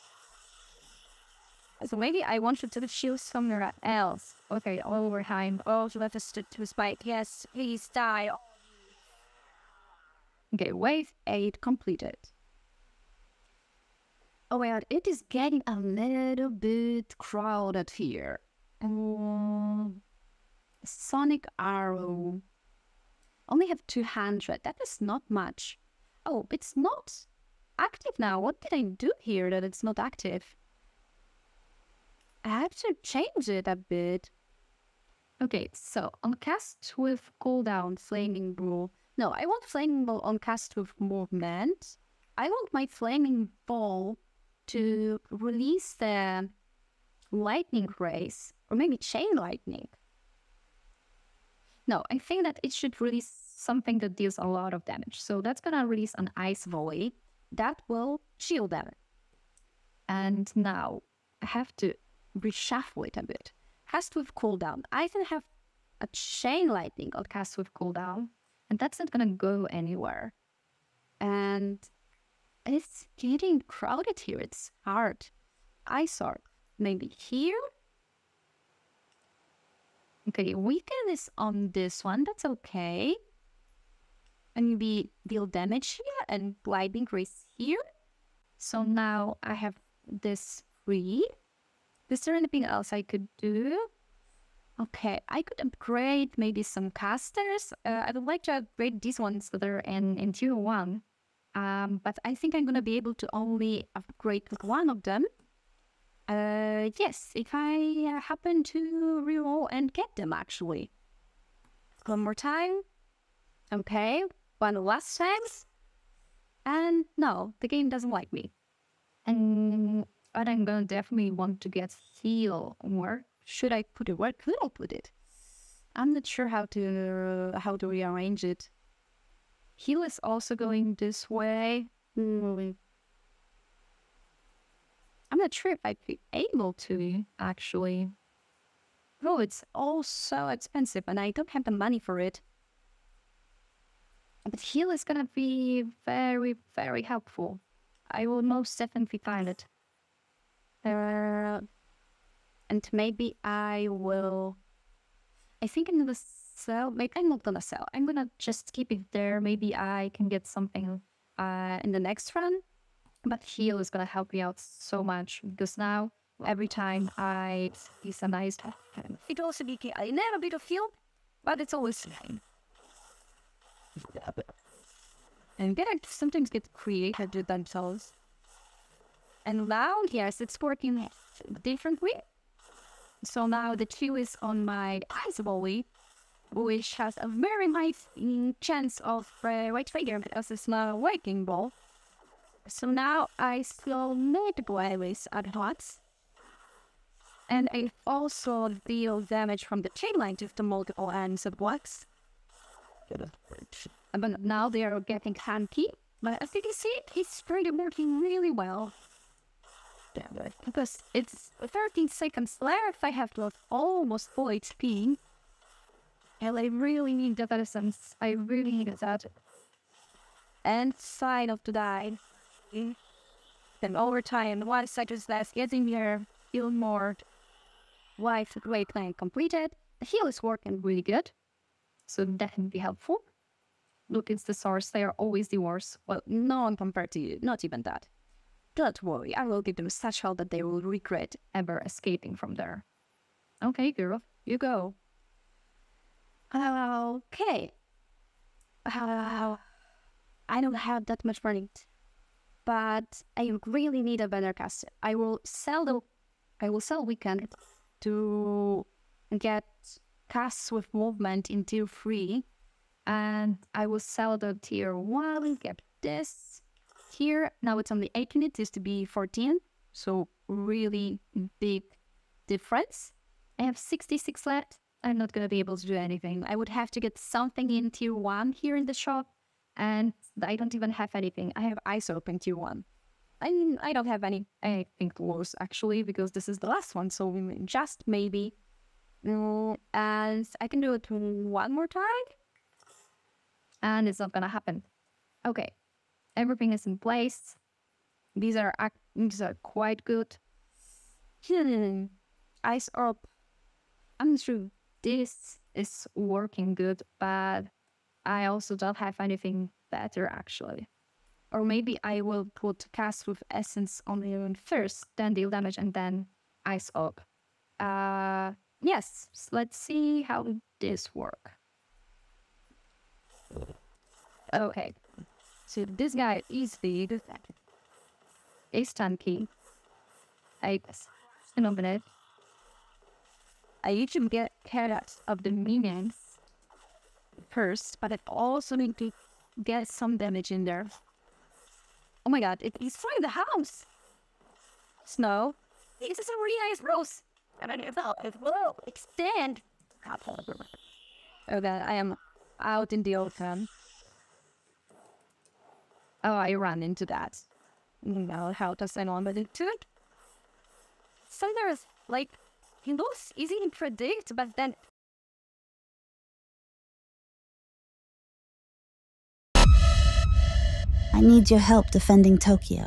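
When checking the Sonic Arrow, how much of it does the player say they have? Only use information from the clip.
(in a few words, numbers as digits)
200.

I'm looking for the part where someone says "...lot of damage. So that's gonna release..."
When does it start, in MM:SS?
00:54.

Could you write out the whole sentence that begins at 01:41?
Um, but I think I'm going to be able to only upgrade one of them.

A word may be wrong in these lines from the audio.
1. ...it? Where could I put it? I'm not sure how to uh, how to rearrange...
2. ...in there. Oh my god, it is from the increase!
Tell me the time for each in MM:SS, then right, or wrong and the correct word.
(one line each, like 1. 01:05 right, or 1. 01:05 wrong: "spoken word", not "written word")
1. 02:04 right
2. 05:40 wrong: "house", not "increase".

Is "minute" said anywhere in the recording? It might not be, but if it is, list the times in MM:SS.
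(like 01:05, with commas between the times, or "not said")
05:31.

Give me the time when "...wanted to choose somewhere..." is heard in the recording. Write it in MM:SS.
00:02.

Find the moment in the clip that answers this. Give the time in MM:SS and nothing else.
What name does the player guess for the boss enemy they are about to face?
05:28.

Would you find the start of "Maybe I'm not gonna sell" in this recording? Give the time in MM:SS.
02:36.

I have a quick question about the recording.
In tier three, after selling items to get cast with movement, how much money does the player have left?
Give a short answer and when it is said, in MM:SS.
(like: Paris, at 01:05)
66, at 04:33.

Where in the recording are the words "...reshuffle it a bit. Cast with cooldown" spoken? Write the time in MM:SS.
01:02.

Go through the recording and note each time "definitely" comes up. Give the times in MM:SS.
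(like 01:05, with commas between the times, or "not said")
02:00, 02:28.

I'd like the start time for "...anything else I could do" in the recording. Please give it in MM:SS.
01:32.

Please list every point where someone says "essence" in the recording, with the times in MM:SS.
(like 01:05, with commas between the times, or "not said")
03:37, 05:13.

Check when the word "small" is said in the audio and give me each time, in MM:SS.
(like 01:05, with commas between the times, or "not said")
03:10.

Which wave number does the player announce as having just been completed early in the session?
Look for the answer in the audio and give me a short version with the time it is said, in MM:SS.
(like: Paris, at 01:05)
8, at 00:10.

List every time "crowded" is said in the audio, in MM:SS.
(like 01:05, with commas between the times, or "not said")
00:17, 01:13.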